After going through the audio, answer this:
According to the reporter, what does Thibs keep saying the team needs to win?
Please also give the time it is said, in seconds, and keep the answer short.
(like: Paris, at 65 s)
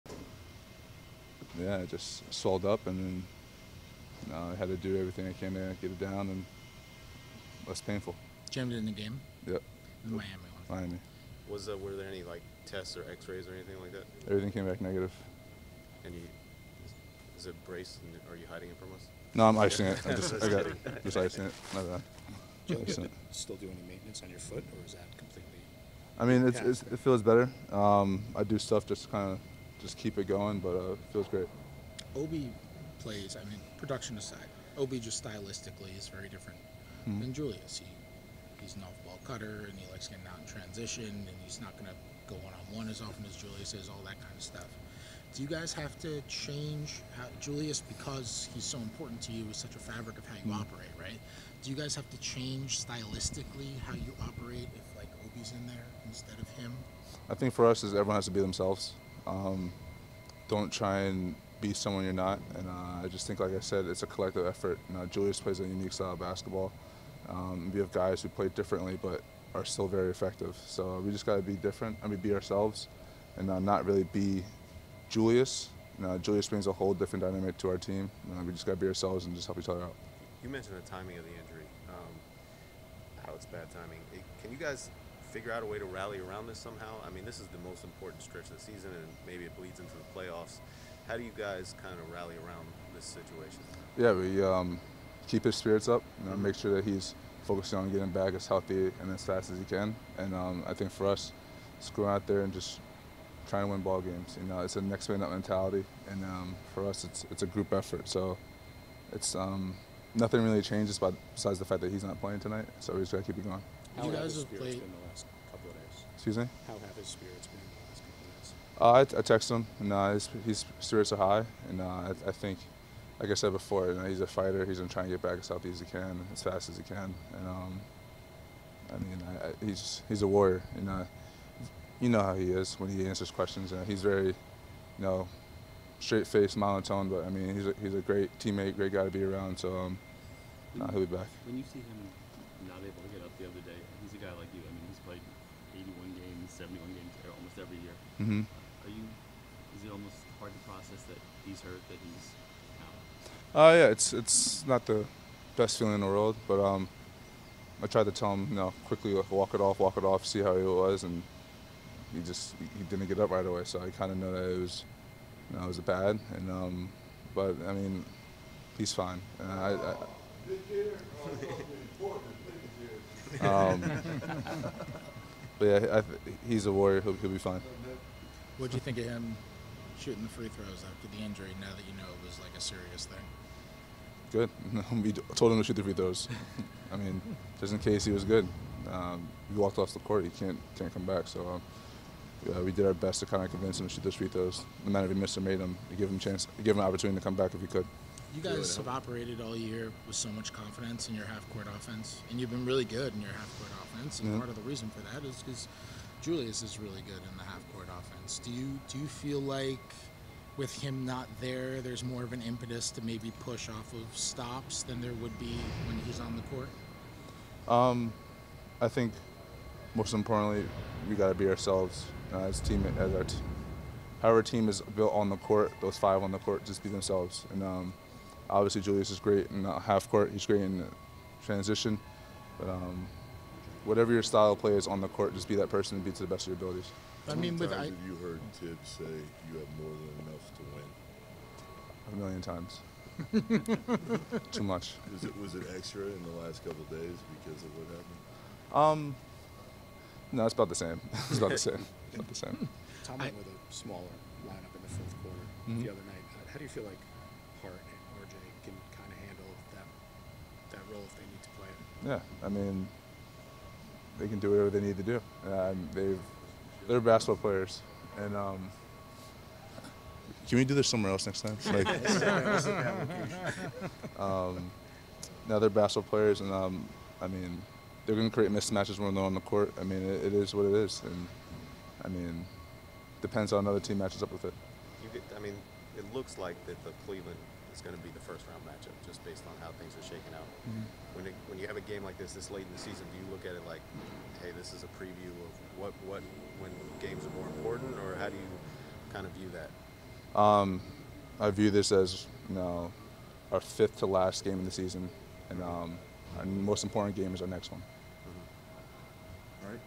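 More than enough, at 239 s.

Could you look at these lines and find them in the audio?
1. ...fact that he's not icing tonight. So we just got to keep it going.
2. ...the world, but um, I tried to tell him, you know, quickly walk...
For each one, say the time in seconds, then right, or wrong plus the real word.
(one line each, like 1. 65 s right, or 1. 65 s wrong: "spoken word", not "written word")
1. 111 s wrong: "playing", not "icing"
2. 156 s right.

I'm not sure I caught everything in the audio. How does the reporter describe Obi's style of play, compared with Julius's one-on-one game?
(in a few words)
Off-ball cutter.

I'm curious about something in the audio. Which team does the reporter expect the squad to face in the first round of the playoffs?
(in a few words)
Cleveland.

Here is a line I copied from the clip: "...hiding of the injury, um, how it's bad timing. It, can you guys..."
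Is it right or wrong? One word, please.
wrong.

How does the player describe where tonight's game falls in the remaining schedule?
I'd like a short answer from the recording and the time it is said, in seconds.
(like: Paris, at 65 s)
Fifth to last, at 303 s.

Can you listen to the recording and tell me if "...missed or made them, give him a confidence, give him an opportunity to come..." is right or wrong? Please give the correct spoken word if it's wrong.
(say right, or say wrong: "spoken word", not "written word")
wrong: "chance", not "confidence".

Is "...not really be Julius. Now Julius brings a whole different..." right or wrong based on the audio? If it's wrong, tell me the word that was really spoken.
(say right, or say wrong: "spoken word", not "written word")
right.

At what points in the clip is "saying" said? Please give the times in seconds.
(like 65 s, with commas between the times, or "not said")
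not said.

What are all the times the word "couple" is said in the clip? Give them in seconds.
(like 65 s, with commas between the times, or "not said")
118 s, 246 s.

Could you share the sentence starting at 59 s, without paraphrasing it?
Um, don't try and be someone you're not.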